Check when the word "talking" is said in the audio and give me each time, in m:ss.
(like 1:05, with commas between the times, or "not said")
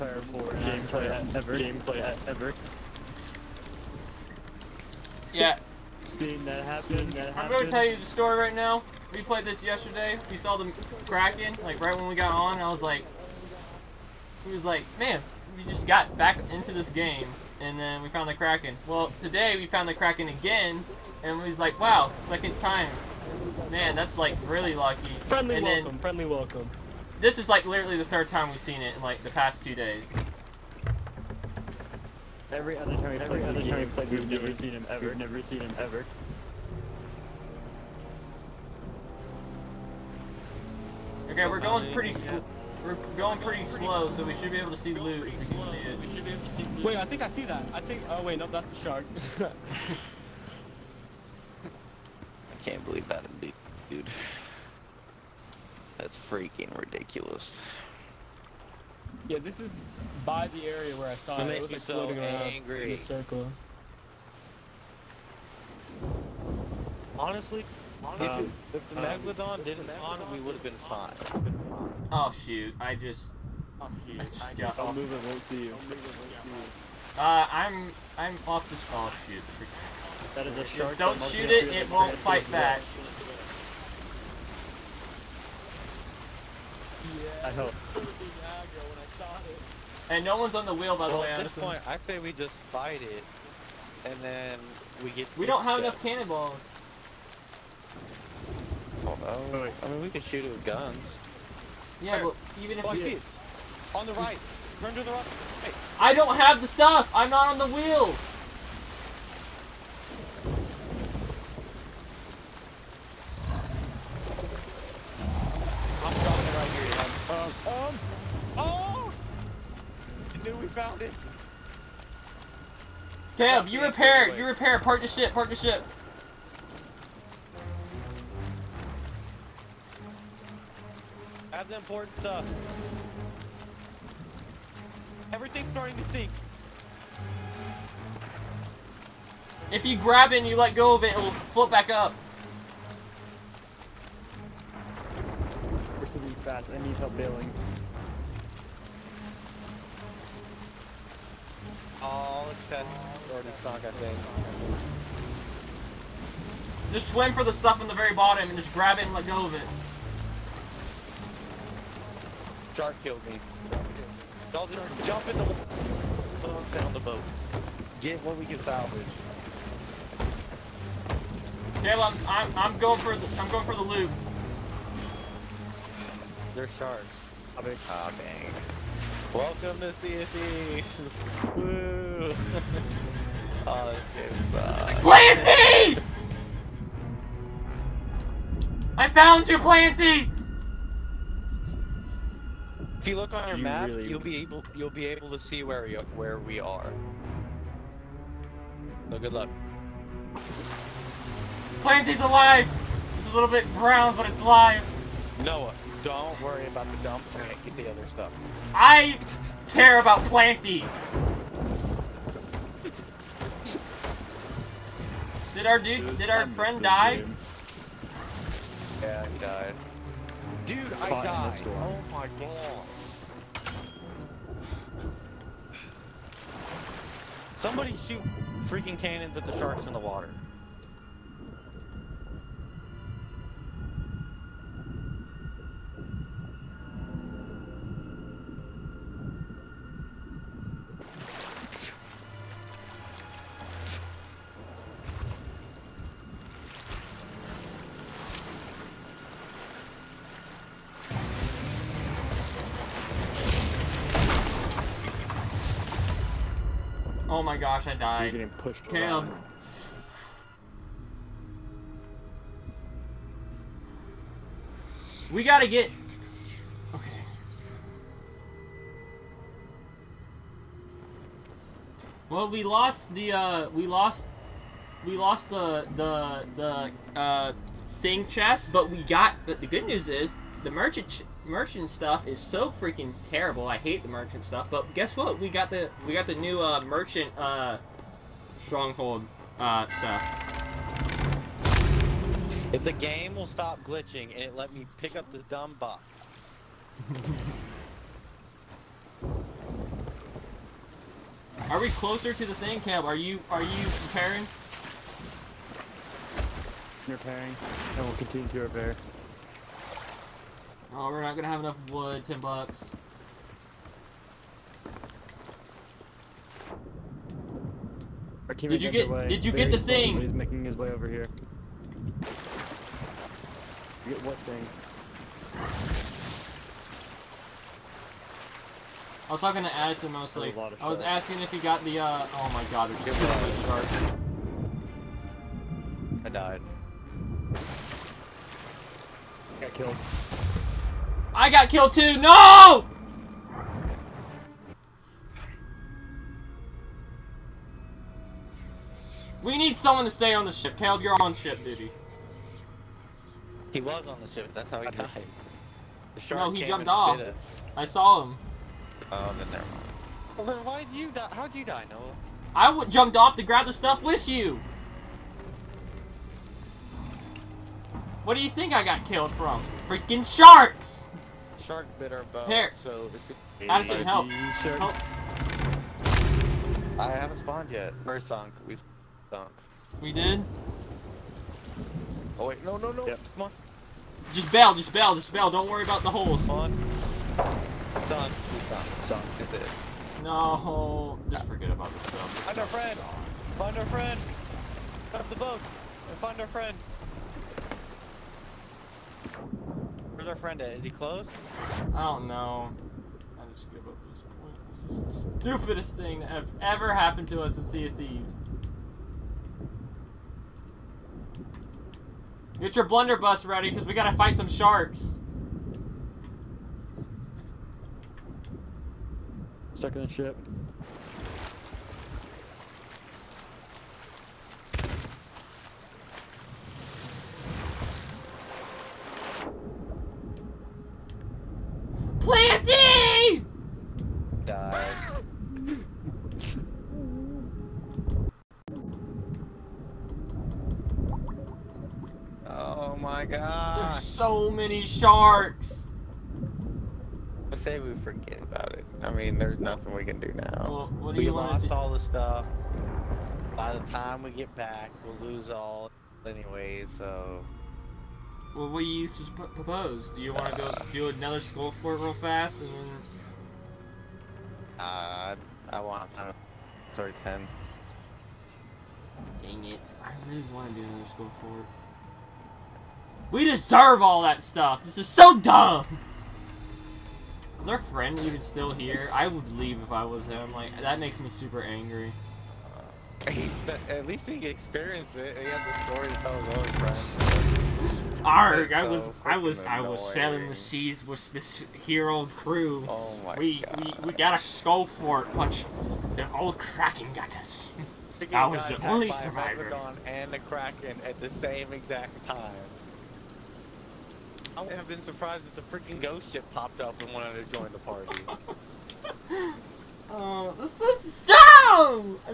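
5:29.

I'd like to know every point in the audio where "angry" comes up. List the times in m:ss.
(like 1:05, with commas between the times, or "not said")
1:02, 8:01.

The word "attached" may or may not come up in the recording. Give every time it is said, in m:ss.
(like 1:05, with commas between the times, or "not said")
not said.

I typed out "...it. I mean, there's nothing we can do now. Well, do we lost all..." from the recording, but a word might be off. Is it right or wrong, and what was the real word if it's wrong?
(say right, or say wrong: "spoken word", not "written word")
right.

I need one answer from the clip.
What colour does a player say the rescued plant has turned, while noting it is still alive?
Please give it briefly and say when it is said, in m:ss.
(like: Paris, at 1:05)
Brown, at 3:23.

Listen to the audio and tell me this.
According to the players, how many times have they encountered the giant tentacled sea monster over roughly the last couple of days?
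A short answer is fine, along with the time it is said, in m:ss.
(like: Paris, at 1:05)
3, at 0:28.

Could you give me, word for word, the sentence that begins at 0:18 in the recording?
Well, today we found the Kraken again, and we was like, wow, second time.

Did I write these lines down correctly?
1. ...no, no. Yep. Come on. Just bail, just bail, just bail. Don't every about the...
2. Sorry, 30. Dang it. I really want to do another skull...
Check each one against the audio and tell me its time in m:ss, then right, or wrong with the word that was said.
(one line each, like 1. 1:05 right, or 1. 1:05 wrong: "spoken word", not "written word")
1. 6:22 wrong: "worry", not "every"
2. 7:46 wrong: "10", not "30".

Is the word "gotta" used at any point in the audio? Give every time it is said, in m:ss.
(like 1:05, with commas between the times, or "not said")
4:25, 6:53.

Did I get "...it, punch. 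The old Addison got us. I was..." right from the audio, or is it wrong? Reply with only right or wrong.
wrong.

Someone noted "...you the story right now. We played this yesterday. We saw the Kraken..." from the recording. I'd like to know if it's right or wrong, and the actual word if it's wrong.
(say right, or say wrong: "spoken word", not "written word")
right.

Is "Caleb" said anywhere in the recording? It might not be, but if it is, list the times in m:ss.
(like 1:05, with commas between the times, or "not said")
2:51, 5:50.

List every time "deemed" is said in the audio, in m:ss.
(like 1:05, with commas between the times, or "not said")
not said.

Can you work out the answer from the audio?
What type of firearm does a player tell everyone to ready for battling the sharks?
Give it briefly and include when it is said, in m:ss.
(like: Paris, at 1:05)
Blunderbuss, at 6:52.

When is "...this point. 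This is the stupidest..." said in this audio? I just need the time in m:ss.
6:44.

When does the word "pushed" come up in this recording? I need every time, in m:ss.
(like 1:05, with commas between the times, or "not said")
4:18.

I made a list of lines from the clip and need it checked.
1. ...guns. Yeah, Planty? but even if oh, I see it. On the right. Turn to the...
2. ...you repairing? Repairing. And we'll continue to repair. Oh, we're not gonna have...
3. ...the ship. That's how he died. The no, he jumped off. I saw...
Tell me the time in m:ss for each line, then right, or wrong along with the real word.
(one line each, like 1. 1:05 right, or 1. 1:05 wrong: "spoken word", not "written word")
1. 1:40 wrong: "Where", not "Planty"
2. 5:03 right
3. 5:54 right.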